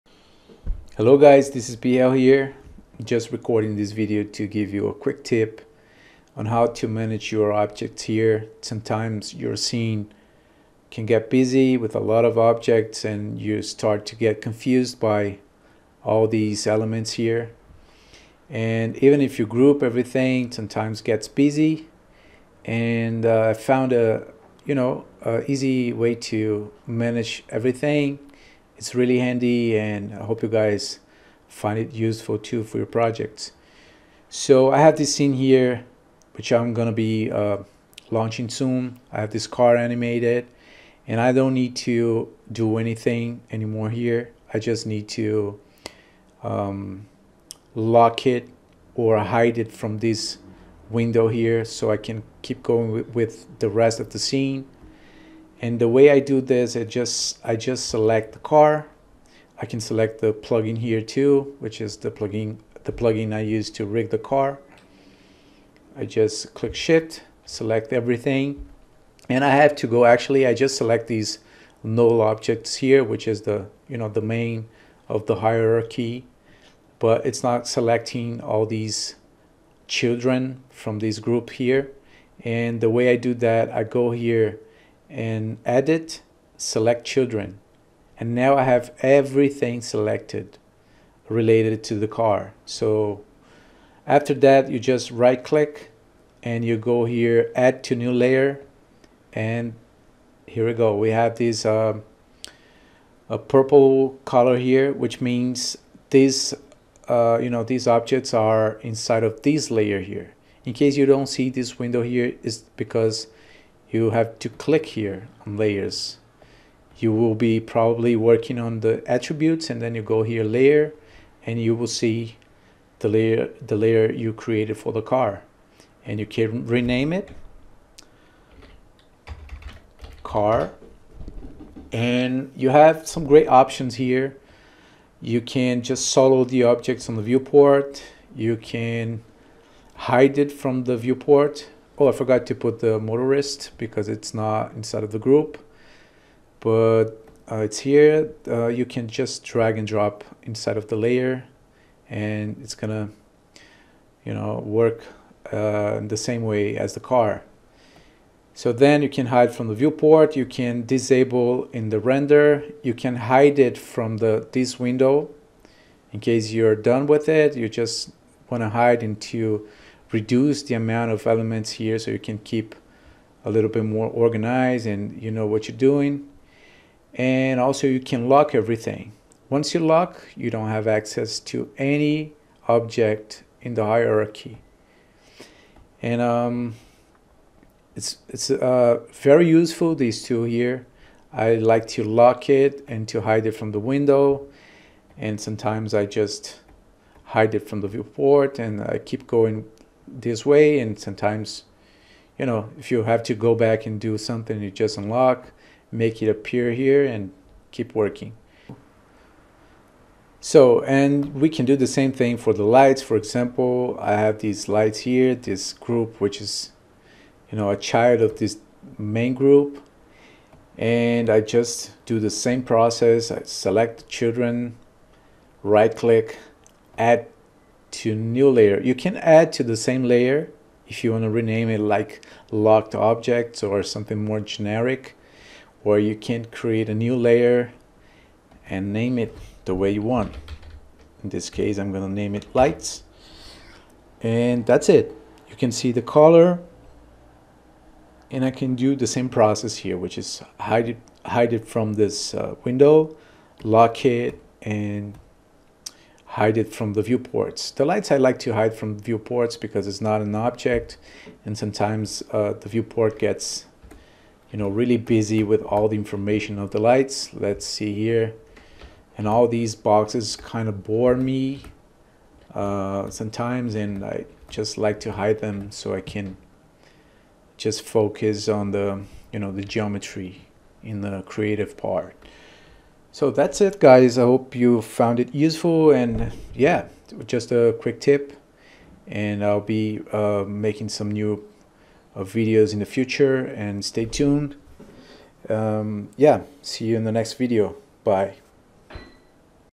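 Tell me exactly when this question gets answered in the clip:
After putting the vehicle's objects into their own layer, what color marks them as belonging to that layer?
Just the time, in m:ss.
1:43.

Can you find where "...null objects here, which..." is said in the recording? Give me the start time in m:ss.
1:11.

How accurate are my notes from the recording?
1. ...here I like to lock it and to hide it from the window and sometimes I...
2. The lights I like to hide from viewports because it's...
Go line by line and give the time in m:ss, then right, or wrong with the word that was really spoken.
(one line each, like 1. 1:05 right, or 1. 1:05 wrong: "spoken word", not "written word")
1. 3:10 right
2. 4:17 right.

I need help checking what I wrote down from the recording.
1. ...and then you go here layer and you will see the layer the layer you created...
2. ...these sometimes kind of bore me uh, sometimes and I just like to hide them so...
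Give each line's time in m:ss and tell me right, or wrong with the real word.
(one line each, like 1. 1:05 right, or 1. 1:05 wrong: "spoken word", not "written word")
1. 1:59 right
2. 4:29 wrong: "boxes", not "sometimes".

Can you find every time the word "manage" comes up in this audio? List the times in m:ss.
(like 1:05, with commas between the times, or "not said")
0:06, 0:26.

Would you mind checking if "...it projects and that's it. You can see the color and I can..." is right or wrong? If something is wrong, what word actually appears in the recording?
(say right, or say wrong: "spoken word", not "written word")
wrong: "lights", not "projects".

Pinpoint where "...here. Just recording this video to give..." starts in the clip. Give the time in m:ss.
0:02.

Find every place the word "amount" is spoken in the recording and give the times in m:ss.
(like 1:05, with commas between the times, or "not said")
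2:50.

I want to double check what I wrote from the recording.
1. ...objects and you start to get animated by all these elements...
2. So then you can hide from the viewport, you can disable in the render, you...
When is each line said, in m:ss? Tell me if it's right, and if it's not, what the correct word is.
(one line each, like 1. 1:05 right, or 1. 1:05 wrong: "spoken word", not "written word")
1. 0:12 wrong: "confused", not "animated"
2. 2:38 right.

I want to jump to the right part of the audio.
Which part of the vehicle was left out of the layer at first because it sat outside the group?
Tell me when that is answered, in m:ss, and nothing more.
2:22.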